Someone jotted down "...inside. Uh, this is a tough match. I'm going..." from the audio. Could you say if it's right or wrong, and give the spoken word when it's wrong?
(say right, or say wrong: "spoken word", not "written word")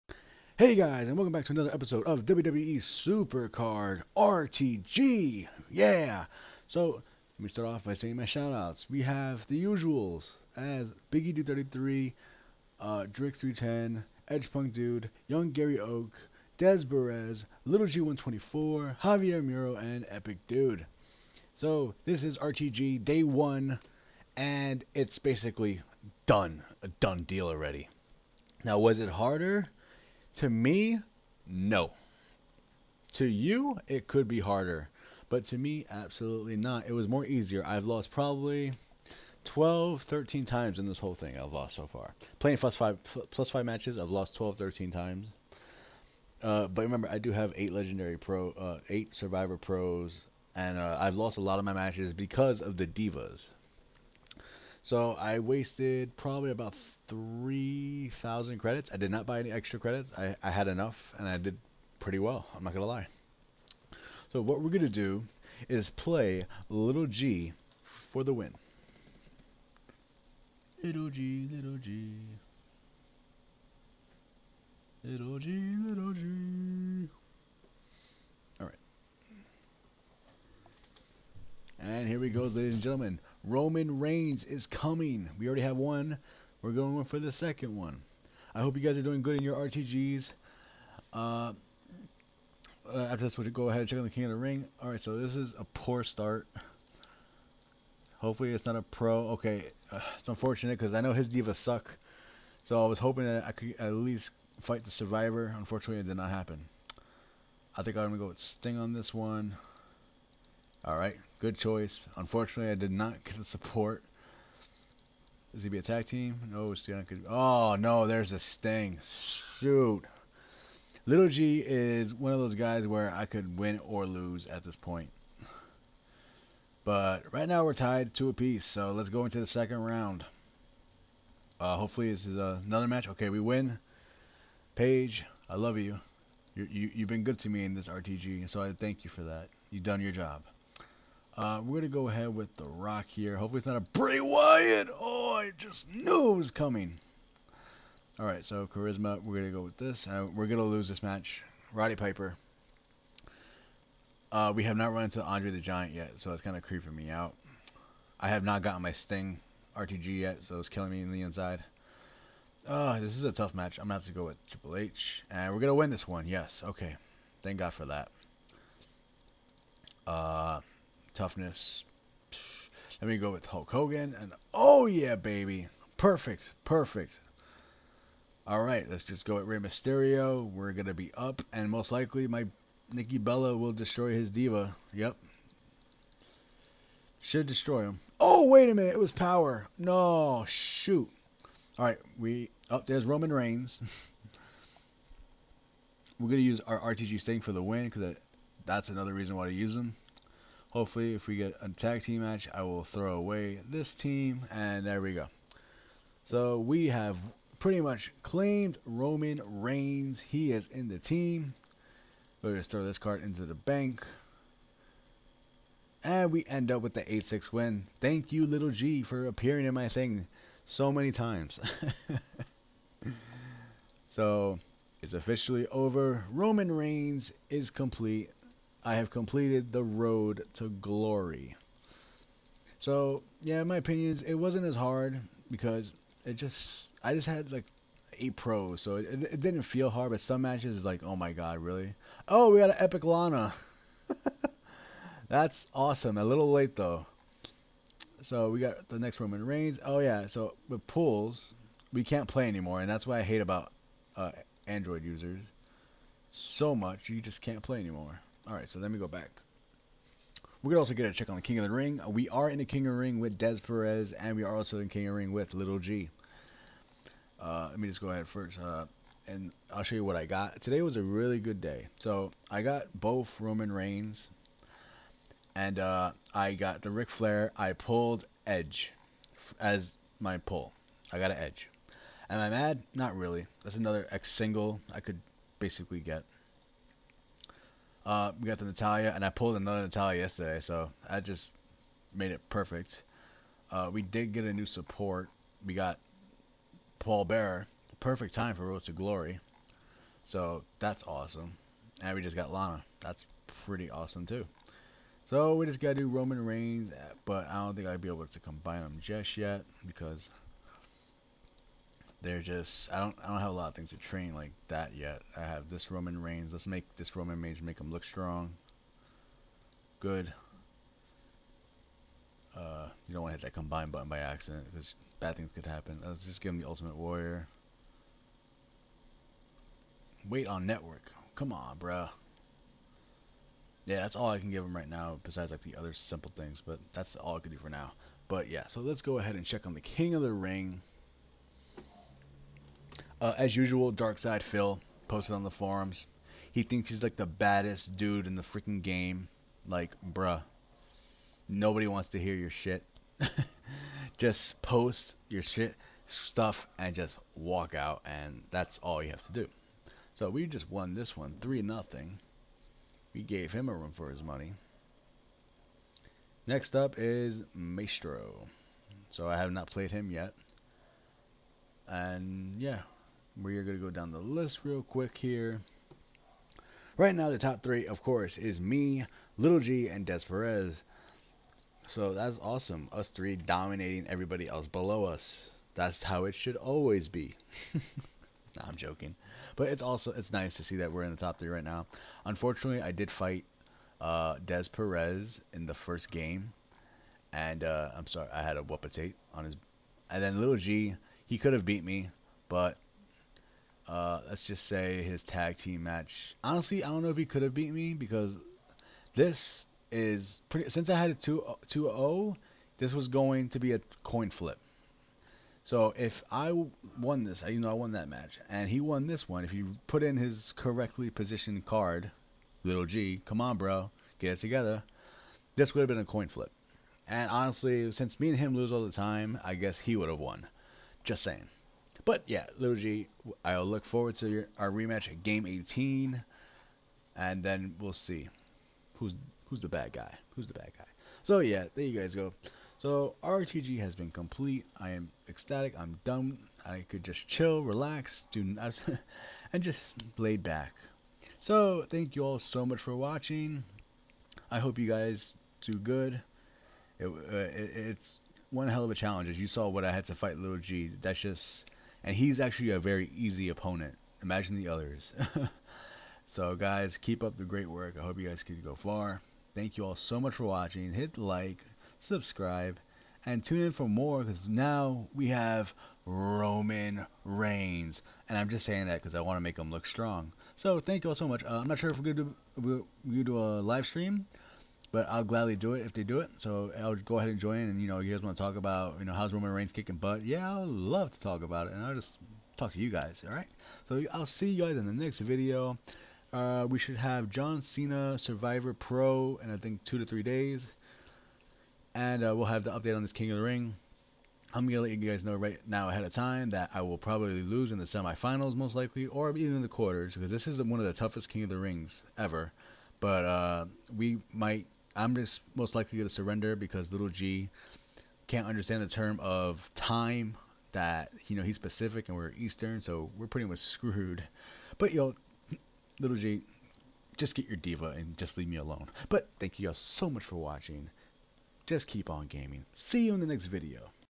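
right.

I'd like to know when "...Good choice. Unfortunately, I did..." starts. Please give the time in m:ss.
1:51.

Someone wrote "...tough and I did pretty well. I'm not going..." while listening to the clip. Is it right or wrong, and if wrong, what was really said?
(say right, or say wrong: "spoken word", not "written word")
wrong: "enough", not "tough".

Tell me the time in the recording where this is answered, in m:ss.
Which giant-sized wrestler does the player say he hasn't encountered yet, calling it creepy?
2:35.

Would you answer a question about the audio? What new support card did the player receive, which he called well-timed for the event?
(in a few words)
Paul Bearer.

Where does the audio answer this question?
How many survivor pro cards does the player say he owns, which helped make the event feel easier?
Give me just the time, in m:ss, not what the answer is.
0:48.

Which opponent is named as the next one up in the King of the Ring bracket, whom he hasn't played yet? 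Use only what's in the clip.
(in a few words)
Maestro.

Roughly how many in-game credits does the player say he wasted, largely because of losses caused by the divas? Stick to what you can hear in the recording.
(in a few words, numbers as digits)
3,000.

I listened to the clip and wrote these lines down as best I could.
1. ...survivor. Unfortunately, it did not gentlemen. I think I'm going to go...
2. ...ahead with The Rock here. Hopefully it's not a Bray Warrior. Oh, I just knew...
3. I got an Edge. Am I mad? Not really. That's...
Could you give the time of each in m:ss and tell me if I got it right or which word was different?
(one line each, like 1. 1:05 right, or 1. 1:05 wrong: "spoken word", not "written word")
1. 1:44 wrong: "happen", not "gentlemen"
2. 2:22 wrong: "Wyatt", not "Warrior"
3. 4:41 right.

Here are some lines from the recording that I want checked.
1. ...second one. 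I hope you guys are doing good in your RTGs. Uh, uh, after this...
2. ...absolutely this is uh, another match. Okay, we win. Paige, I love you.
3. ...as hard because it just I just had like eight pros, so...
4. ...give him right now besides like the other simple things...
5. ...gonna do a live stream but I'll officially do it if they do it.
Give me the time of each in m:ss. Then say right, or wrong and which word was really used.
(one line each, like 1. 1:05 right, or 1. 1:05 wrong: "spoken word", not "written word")
1. 1:27 right
2. 2:11 wrong: "hopefully", not "absolutely"
3. 3:54 right
4. 5:34 right
5. 8:03 wrong: "gladly", not "officially".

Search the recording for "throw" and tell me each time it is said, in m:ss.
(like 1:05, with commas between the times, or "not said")
3:22, 3:32.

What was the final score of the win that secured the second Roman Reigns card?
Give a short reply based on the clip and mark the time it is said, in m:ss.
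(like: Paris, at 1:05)
8-6, at 3:37.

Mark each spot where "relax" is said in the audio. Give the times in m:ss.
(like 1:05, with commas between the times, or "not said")
7:27.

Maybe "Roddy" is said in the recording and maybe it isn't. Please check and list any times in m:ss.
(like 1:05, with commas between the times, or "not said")
2:31.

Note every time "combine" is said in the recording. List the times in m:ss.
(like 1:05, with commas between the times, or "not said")
5:08, 5:23.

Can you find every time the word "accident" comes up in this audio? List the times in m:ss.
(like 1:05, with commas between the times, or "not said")
5:24.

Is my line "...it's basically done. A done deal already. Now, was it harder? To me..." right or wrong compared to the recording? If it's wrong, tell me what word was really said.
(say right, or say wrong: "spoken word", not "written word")
right.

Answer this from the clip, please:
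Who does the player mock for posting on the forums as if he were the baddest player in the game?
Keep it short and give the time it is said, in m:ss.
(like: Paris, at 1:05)
Darkside Phil, at 5:43.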